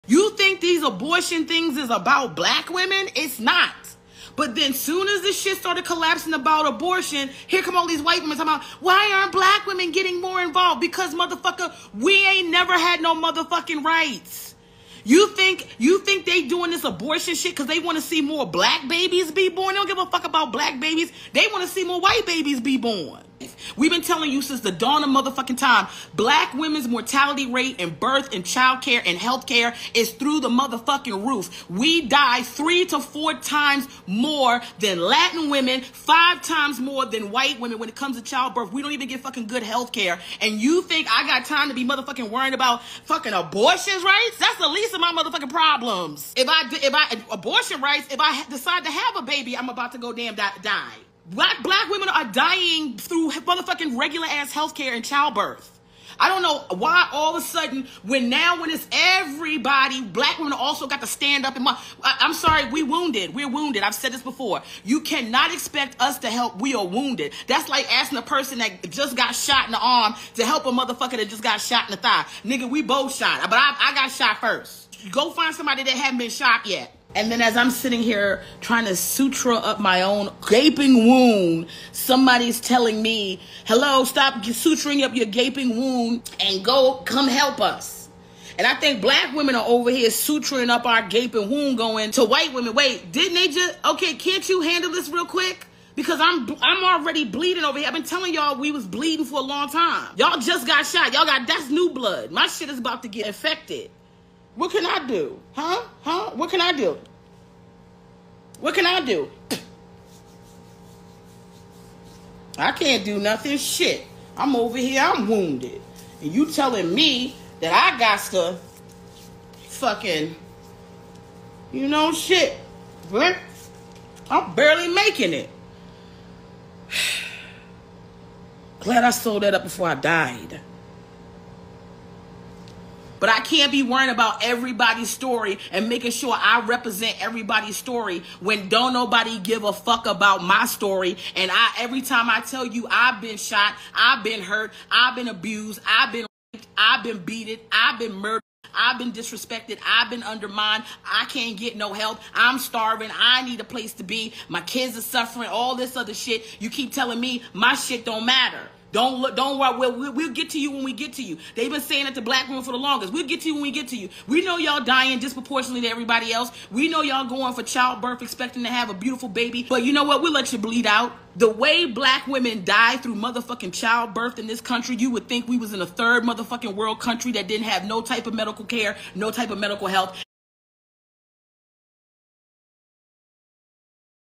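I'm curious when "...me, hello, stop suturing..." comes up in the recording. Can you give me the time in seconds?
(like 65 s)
83 s.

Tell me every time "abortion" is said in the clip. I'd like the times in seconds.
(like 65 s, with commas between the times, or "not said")
0 s, 6 s, 16 s, 43 s, 47 s.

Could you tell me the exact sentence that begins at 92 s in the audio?
Wait, didn't they just, okay, can't you handle this real quick?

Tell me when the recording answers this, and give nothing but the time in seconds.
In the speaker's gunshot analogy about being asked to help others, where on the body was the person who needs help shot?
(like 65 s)
72 s.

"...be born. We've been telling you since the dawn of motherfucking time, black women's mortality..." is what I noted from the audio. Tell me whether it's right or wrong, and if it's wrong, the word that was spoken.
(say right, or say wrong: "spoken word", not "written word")
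right.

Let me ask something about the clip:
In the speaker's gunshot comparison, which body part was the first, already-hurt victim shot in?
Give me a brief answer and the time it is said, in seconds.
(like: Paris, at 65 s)
arm, at 69 s.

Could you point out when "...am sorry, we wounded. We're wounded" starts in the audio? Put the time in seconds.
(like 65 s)
62 s.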